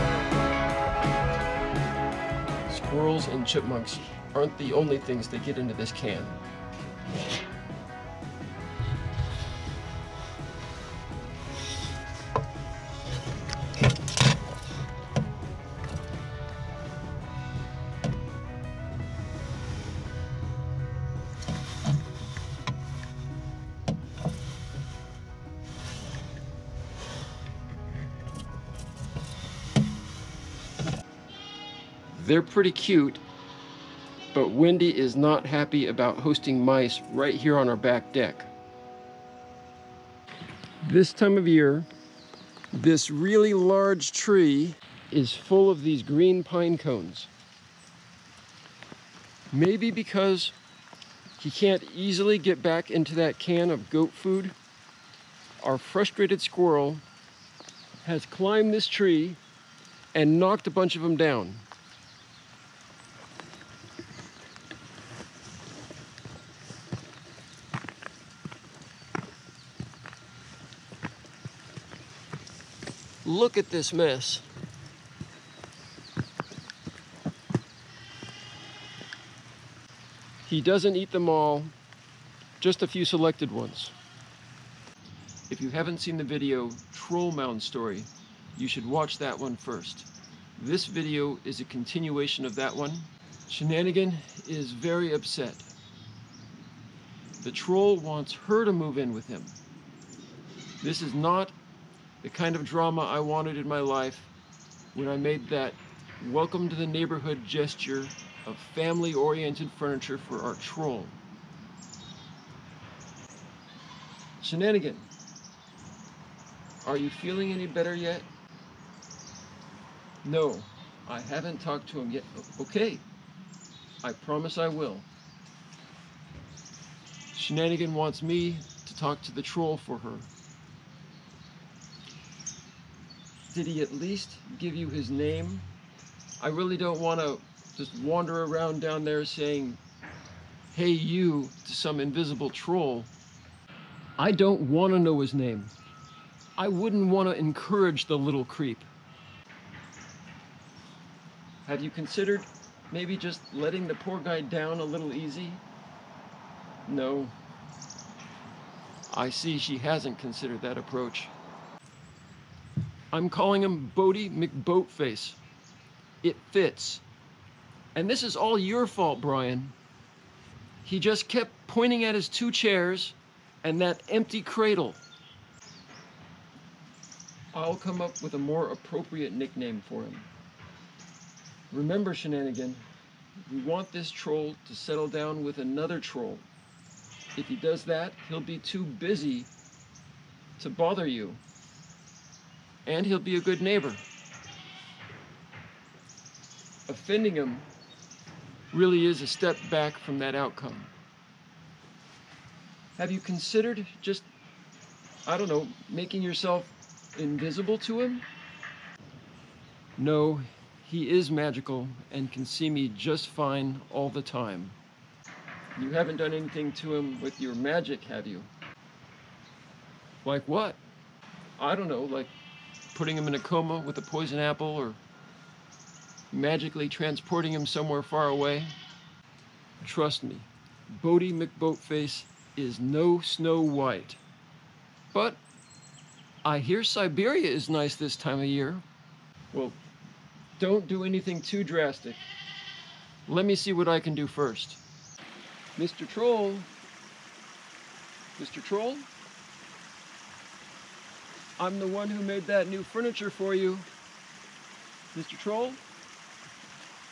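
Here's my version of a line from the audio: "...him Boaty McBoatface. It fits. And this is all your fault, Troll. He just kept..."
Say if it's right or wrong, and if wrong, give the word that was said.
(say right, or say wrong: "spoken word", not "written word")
wrong: "Bryan", not "Troll".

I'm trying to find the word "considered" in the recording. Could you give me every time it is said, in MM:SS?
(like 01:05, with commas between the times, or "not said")
02:31, 02:40, 03:23.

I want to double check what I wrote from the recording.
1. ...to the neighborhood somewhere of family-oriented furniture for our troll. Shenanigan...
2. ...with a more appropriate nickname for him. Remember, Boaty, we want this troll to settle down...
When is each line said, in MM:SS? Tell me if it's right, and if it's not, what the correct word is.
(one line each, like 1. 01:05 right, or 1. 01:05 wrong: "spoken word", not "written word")
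1. 01:46 wrong: "gesture", not "somewhere"
2. 02:58 wrong: "Shenanigan", not "Boaty".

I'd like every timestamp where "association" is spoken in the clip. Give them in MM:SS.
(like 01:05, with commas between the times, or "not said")
not said.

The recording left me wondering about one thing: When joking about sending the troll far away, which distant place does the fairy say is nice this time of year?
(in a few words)
Siberia.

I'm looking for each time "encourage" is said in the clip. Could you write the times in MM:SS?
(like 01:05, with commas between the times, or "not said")
02:27.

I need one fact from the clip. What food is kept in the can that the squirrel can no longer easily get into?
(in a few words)
Goat food.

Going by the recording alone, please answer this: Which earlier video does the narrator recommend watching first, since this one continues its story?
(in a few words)
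Troll Mound Story.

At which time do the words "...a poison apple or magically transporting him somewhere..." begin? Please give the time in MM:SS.
03:43.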